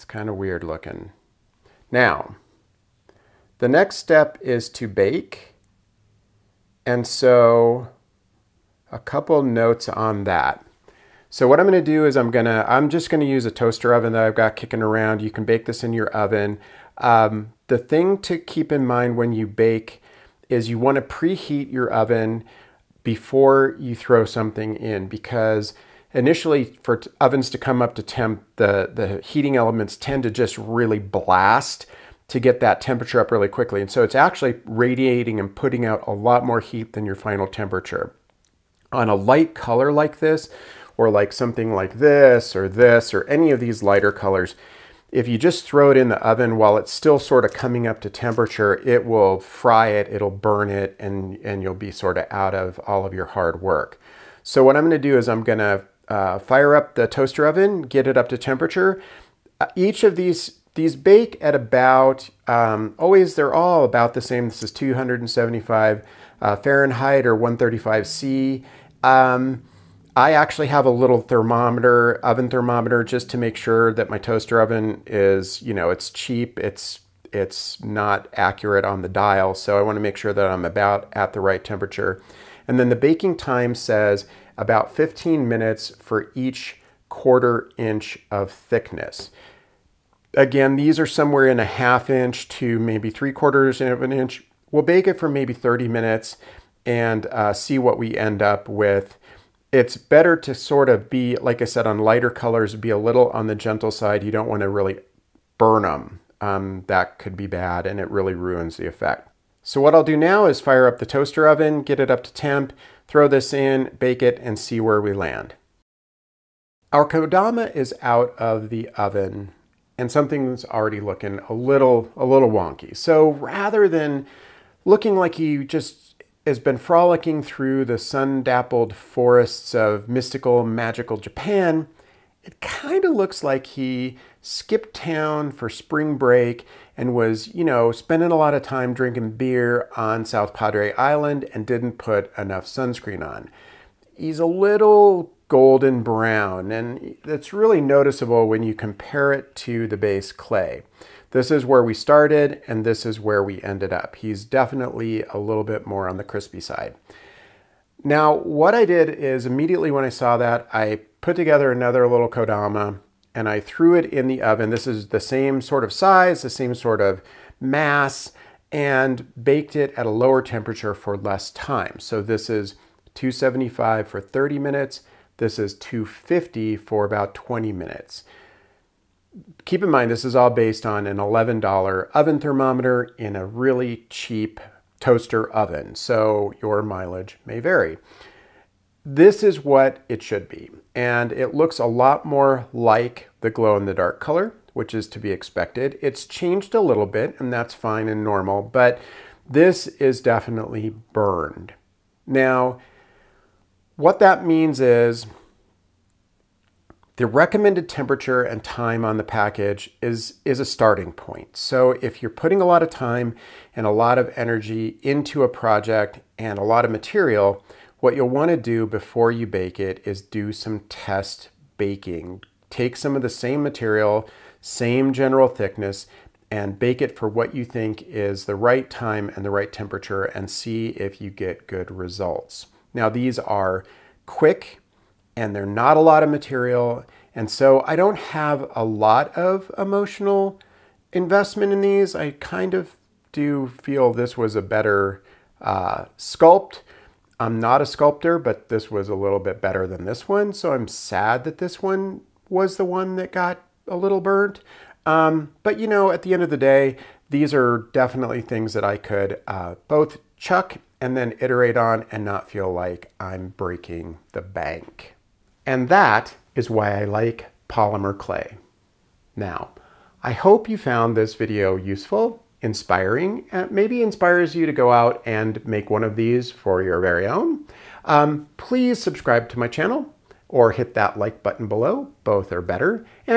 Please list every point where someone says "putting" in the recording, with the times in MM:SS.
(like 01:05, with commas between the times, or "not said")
00:35, 03:32.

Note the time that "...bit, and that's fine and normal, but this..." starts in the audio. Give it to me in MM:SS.
03:17.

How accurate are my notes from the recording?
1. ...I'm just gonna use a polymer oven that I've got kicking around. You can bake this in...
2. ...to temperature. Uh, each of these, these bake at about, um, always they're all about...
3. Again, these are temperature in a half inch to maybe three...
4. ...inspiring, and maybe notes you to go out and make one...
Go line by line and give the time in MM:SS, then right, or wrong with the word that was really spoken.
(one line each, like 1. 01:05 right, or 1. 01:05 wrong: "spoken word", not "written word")
1. 00:12 wrong: "toaster", not "polymer"
2. 00:58 right
3. 01:30 wrong: "somewhere", not "temperature"
4. 04:32 wrong: "inspires", not "notes".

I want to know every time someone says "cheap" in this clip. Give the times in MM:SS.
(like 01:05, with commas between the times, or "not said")
01:16, 03:04.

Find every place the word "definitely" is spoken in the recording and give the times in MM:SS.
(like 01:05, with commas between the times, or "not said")
02:34, 03:20, 04:17.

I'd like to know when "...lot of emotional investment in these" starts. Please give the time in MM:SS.
03:58.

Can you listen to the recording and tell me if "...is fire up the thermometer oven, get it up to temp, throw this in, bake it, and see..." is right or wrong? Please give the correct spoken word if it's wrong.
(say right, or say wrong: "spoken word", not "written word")
wrong: "toaster", not "thermometer".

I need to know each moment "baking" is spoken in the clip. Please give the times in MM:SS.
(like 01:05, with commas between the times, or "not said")
01:22, 03:41.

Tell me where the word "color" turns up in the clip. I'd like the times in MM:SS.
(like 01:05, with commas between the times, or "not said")
00:39, 00:44, 01:42, 03:14.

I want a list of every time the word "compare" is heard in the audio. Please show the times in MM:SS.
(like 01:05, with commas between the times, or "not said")
02:28.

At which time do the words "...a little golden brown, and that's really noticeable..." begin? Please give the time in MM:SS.
02:24.